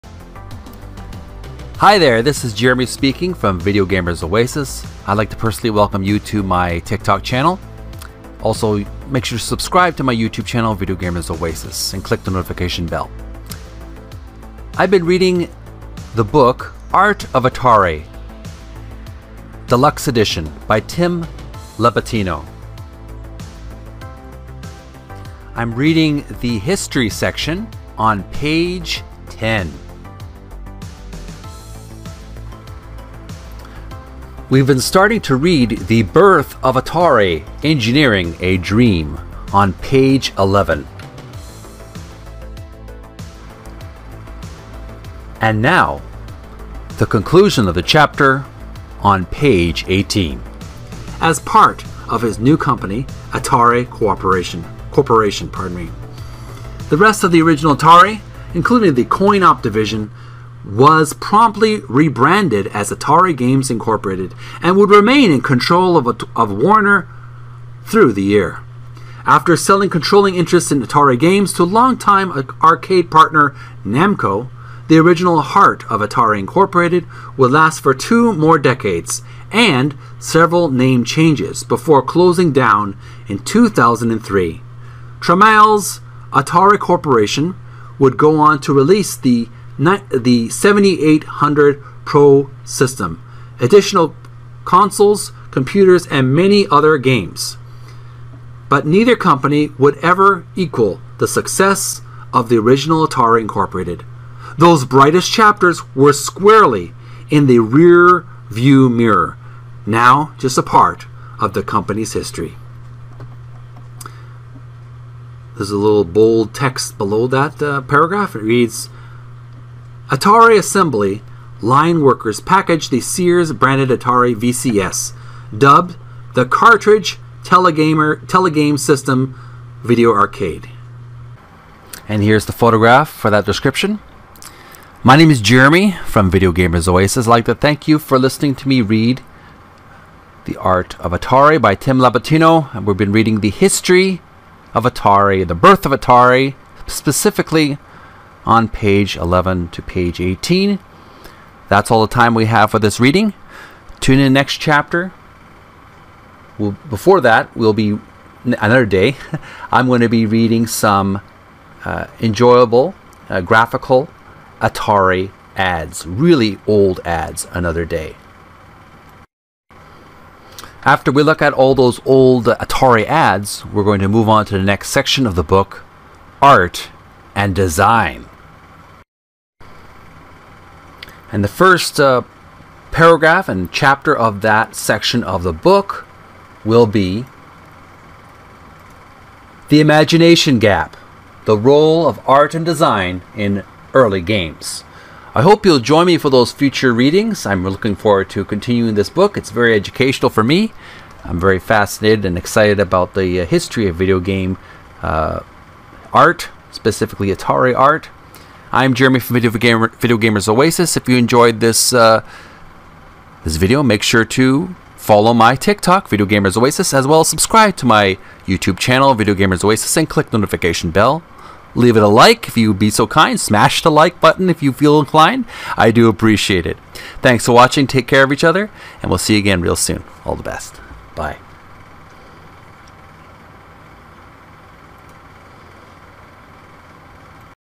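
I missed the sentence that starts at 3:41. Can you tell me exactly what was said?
Leave it a like if you'd be so kind.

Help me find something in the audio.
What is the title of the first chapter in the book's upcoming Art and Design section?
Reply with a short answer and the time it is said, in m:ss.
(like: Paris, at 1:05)
The Imagination Gap, at 3:09.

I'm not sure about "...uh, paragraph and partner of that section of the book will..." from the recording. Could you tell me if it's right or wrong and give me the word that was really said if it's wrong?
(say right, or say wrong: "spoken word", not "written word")
wrong: "chapter", not "partner".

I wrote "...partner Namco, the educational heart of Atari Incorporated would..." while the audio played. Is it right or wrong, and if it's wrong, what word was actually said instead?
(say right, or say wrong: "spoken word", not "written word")
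wrong: "original", not "educational".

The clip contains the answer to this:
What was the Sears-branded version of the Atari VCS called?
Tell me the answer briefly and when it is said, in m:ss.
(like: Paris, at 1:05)
Telegame System Video Arcade, at 2:08.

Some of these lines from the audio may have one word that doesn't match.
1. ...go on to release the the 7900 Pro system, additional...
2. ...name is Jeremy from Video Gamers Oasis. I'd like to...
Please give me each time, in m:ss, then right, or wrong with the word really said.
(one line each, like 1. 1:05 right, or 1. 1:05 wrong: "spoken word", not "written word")
1. 1:28 wrong: "7800", not "7900"
2. 2:15 right.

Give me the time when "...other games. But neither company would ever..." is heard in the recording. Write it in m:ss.
1:36.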